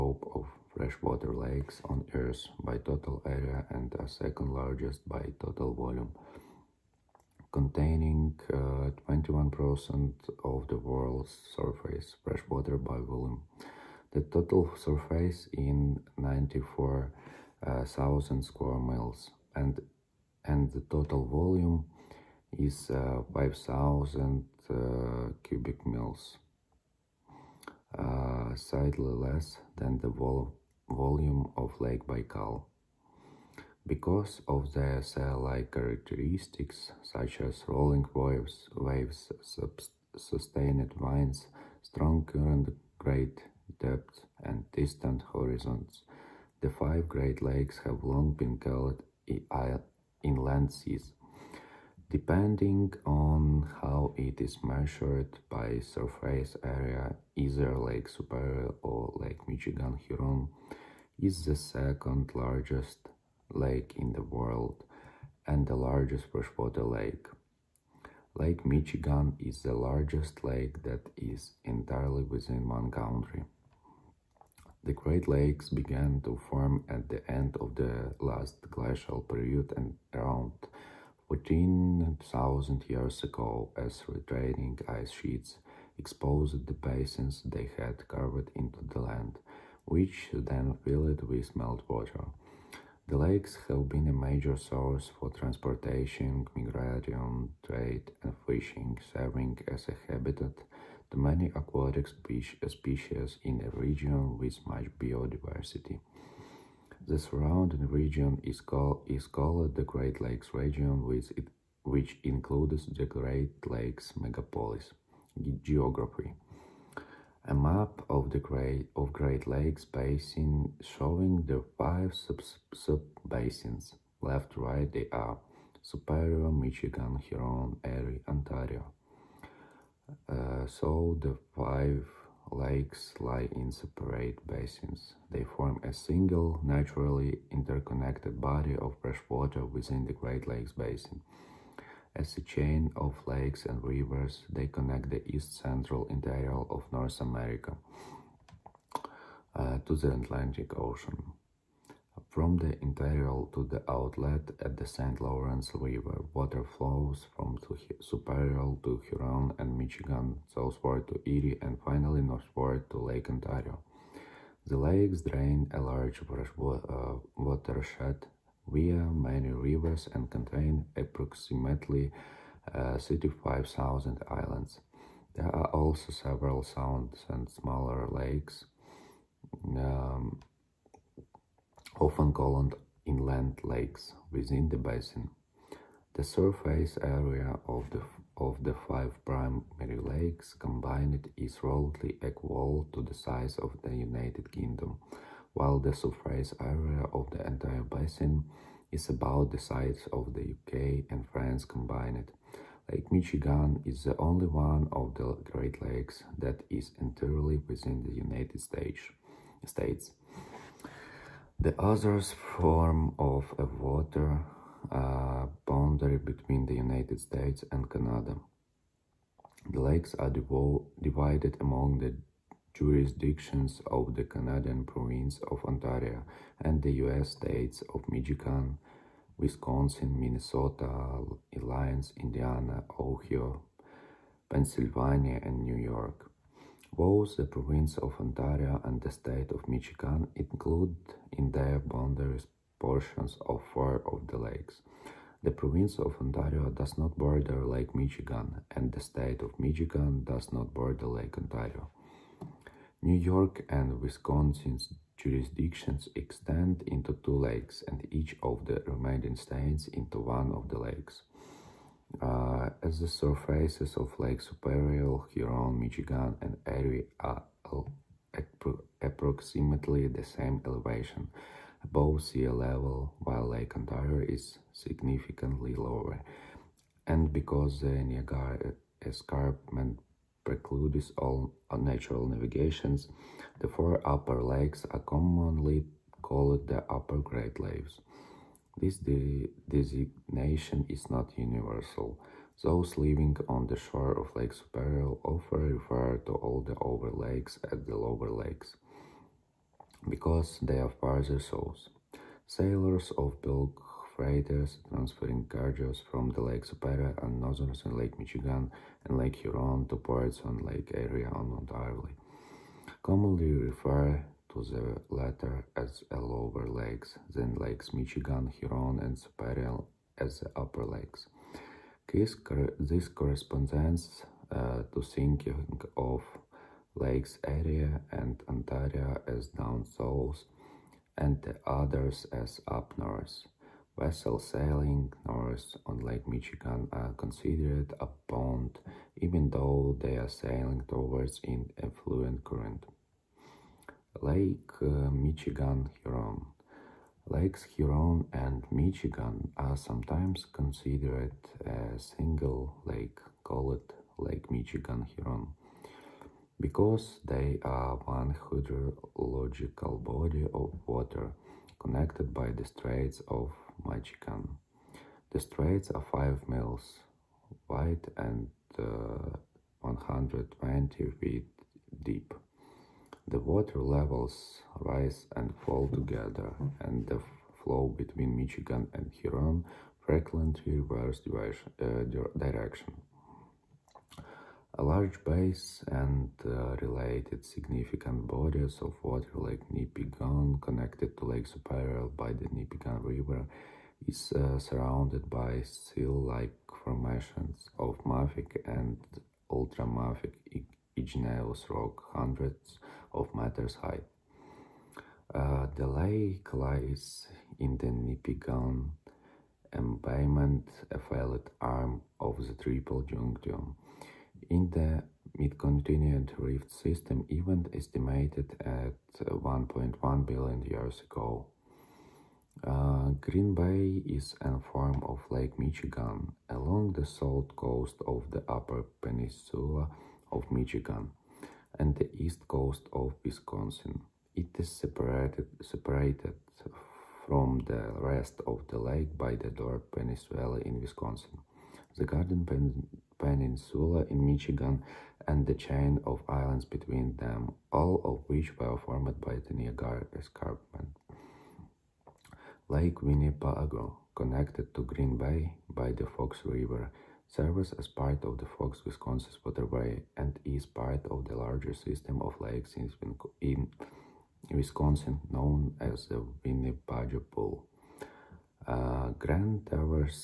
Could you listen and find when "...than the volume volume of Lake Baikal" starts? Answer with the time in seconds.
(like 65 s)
29 s.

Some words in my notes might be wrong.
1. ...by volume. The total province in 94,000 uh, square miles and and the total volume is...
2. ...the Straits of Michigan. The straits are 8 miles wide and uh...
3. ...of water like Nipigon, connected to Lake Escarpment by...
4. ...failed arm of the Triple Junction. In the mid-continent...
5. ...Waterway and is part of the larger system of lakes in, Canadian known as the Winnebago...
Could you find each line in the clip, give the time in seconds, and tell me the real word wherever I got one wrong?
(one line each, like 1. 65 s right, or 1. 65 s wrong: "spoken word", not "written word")
1. 12 s wrong: "surface", not "province"
2. 362 s wrong: "5", not "8"
3. 388 s wrong: "Superior", not "Escarpment"
4. 410 s right
5. 459 s wrong: "Wisconsin", not "Canadian".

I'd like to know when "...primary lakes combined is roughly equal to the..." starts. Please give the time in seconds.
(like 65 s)
189 s.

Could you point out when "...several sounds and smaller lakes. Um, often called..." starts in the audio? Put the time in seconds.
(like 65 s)
176 s.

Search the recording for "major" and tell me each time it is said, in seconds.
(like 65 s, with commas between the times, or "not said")
94 s.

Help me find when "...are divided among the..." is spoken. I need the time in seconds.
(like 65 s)
220 s.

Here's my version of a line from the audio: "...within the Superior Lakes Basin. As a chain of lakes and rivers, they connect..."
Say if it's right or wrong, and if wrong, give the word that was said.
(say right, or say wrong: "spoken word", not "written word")
wrong: "Great", not "Superior".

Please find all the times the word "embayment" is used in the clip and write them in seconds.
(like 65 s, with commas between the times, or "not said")
409 s.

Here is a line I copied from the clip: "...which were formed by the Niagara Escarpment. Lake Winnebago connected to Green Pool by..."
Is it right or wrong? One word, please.
wrong.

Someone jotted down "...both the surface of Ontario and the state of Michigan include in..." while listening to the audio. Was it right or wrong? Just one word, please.
wrong.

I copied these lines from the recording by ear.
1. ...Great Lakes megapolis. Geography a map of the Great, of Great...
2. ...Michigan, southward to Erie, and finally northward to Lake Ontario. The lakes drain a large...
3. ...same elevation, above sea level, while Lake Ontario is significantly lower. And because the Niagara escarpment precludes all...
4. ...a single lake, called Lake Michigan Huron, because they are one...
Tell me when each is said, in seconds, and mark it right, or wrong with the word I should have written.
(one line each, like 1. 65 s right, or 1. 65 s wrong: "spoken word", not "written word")
1. 113 s right
2. 159 s right
3. 270 s right
4. 351 s right.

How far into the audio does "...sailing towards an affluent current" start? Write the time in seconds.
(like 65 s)
340 s.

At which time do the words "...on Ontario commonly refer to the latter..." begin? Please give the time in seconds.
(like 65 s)
311 s.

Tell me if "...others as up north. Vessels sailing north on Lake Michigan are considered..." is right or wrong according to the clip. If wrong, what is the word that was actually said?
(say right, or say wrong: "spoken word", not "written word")
right.